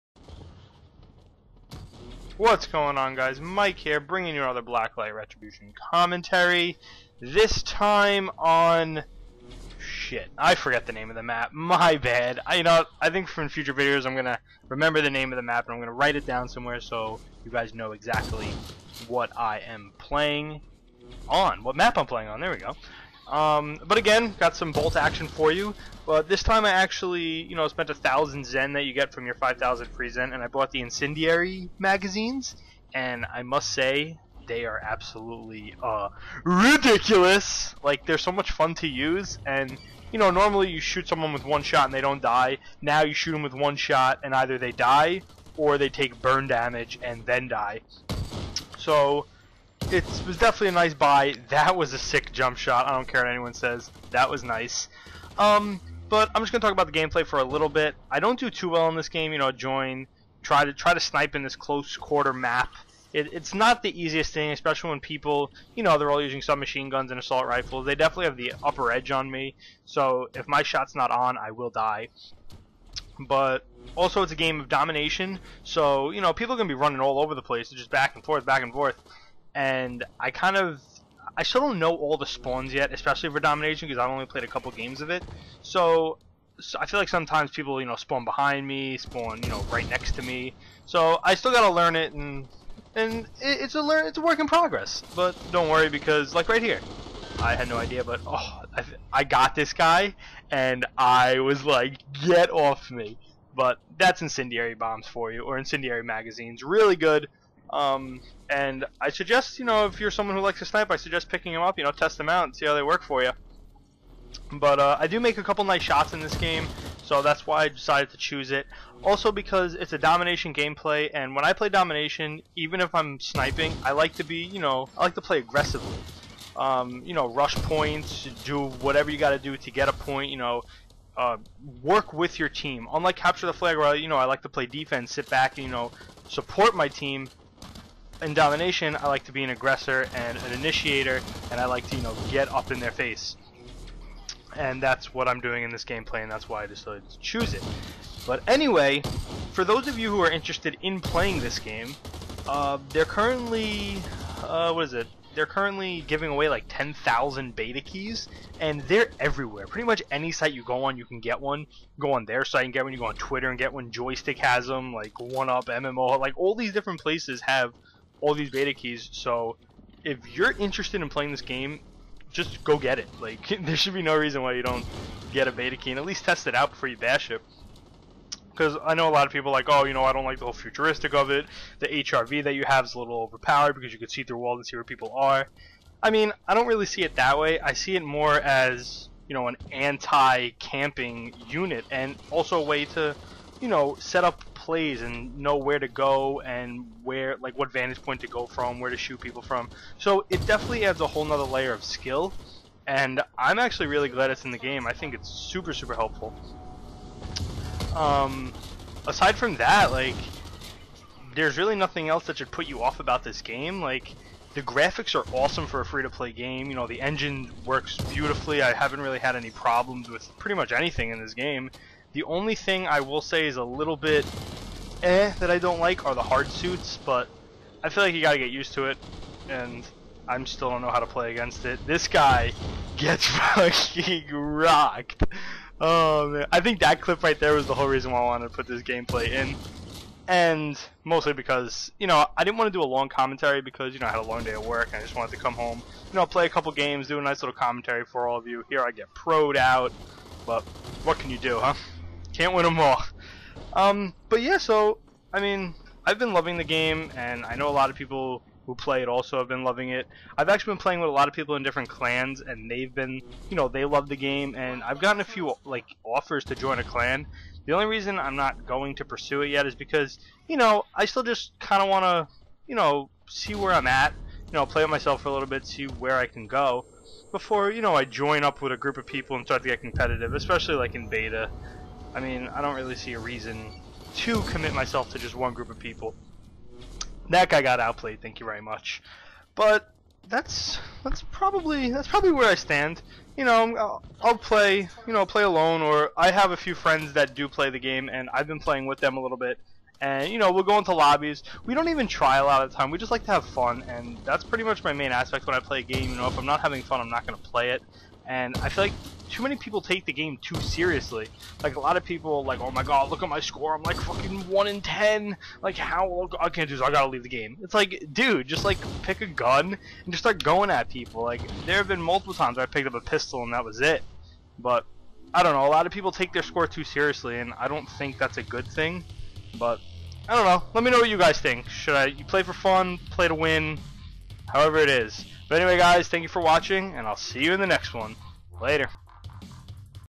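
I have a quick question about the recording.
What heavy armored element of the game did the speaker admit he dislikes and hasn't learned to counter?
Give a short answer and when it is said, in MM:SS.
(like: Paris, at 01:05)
Hard suits, at 03:46.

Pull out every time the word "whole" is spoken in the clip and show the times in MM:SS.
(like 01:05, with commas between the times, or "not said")
03:00, 03:21, 03:57.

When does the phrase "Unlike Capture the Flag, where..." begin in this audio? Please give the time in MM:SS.
02:12.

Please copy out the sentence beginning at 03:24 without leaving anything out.
I think it's super super helpful.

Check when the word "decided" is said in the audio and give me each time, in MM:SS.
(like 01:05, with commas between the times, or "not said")
01:57, 02:26.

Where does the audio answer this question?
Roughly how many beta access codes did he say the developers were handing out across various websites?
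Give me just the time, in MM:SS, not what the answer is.
02:36.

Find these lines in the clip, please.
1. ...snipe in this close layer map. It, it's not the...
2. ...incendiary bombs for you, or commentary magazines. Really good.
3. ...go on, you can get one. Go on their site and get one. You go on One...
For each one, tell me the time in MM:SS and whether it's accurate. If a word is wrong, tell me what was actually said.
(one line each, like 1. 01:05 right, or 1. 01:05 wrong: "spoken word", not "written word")
1. 01:00 wrong: "quarter", not "layer"
2. 01:44 wrong: "incendiary", not "commentary"
3. 02:40 wrong: "Twitter", not "One".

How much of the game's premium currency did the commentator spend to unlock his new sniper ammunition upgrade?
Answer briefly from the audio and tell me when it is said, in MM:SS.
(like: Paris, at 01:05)
1,000 zen, at 00:27.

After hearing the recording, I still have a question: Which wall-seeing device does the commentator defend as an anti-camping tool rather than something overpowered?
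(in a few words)
HRV.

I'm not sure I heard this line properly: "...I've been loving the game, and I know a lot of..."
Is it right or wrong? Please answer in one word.
right.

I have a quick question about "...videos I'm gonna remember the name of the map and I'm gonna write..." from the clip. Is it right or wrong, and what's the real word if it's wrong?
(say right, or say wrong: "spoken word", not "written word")
right.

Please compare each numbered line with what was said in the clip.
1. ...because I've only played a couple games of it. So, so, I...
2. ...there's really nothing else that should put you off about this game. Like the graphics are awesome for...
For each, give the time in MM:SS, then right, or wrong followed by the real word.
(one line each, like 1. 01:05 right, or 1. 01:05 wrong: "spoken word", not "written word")
1. 01:23 right
2. 03:31 right.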